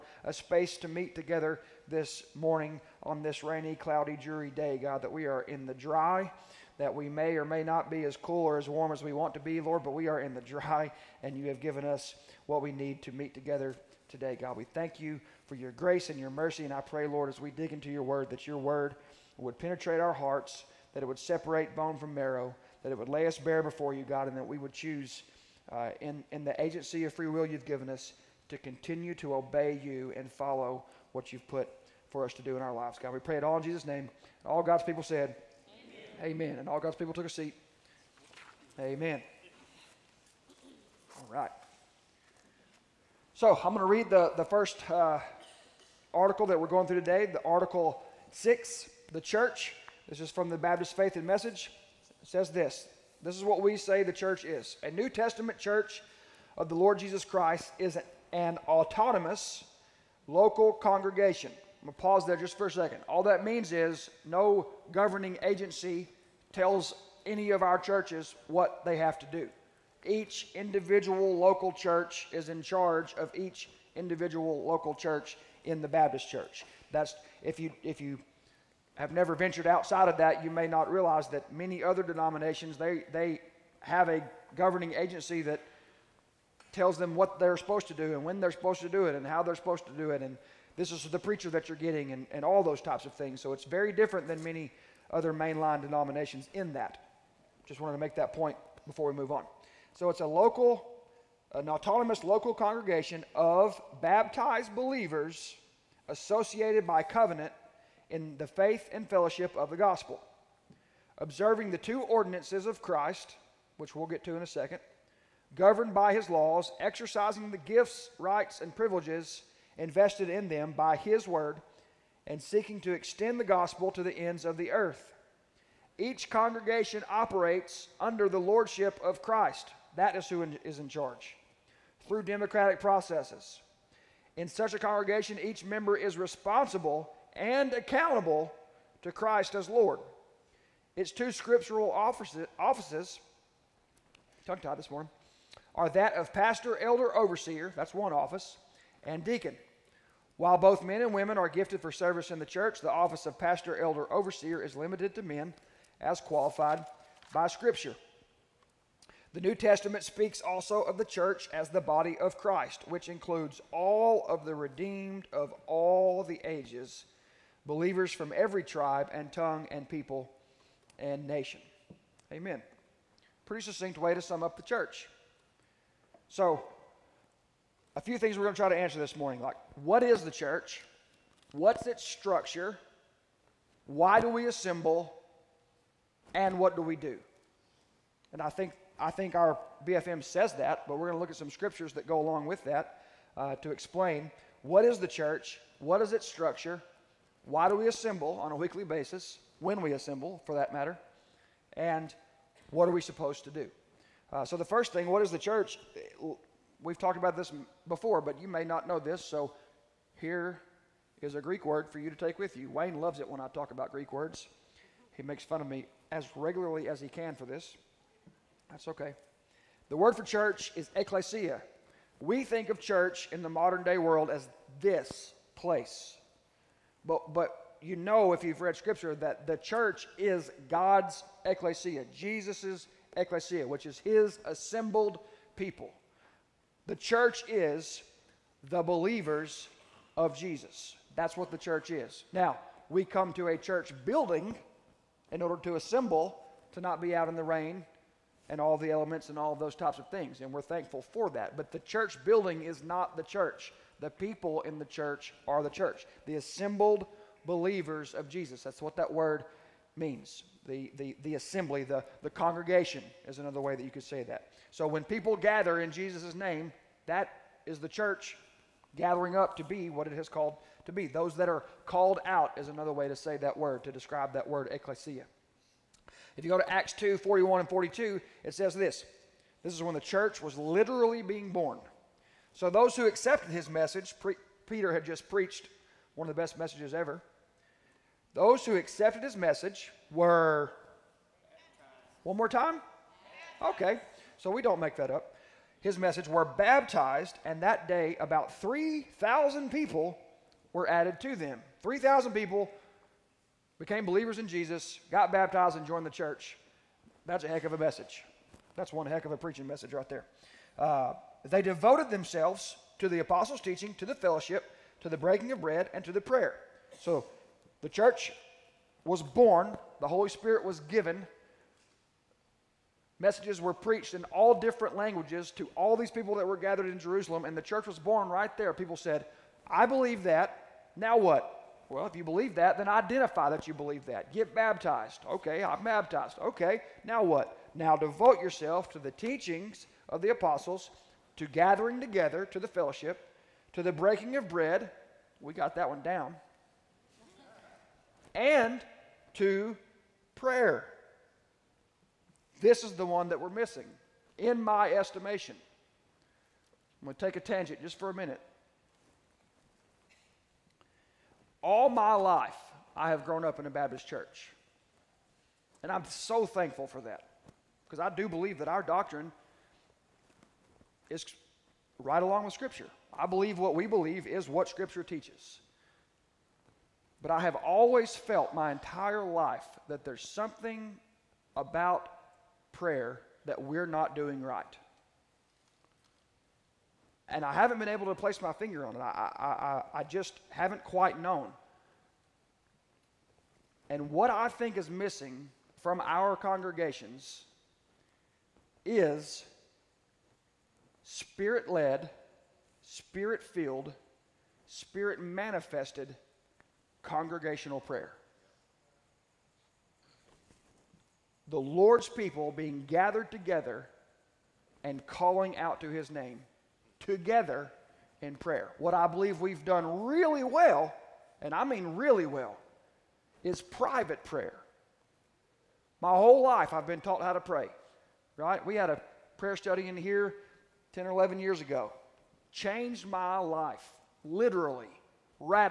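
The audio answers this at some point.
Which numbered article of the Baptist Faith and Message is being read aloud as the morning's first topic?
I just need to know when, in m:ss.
0:47.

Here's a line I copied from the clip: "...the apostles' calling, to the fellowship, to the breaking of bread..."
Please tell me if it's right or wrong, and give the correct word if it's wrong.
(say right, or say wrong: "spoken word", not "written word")
wrong: "teaching", not "calling".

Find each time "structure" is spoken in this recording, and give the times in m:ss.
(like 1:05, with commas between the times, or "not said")
3:02, 3:16.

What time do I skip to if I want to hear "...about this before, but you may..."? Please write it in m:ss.
3:27.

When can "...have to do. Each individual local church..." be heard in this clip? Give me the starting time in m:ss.
1:08.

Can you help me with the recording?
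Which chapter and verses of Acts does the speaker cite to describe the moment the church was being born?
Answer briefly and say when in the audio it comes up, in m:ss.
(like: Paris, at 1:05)
Acts 2:41-42, at 4:36.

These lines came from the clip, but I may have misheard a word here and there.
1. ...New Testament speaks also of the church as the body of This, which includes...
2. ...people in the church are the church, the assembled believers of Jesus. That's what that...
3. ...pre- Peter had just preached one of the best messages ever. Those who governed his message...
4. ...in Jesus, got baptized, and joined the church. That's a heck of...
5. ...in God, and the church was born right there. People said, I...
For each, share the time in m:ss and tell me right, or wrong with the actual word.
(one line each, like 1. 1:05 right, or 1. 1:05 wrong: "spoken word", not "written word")
1. 2:39 wrong: "Christ", not "This"
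2. 4:14 right
3. 4:44 wrong: "accepted", not "governed"
4. 5:04 right
5. 5:26 wrong: "Jerusalem", not "God".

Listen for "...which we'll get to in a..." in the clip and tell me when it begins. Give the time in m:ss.
1:53.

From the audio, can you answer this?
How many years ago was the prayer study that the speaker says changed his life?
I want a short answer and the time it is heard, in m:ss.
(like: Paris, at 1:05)
10 or 11 years, at 7:10.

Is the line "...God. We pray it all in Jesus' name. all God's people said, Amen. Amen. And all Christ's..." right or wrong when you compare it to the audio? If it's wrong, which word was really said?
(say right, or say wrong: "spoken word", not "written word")
wrong: "God", not "Christ".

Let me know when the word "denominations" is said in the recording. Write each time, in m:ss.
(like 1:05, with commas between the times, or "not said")
1:22, 1:35.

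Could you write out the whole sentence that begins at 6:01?
all my life, I have grown up in a Baptist church.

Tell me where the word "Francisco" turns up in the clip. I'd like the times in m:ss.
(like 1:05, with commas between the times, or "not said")
not said.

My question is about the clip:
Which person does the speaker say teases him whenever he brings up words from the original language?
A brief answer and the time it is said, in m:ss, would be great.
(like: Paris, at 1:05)
Wayne, at 3:32.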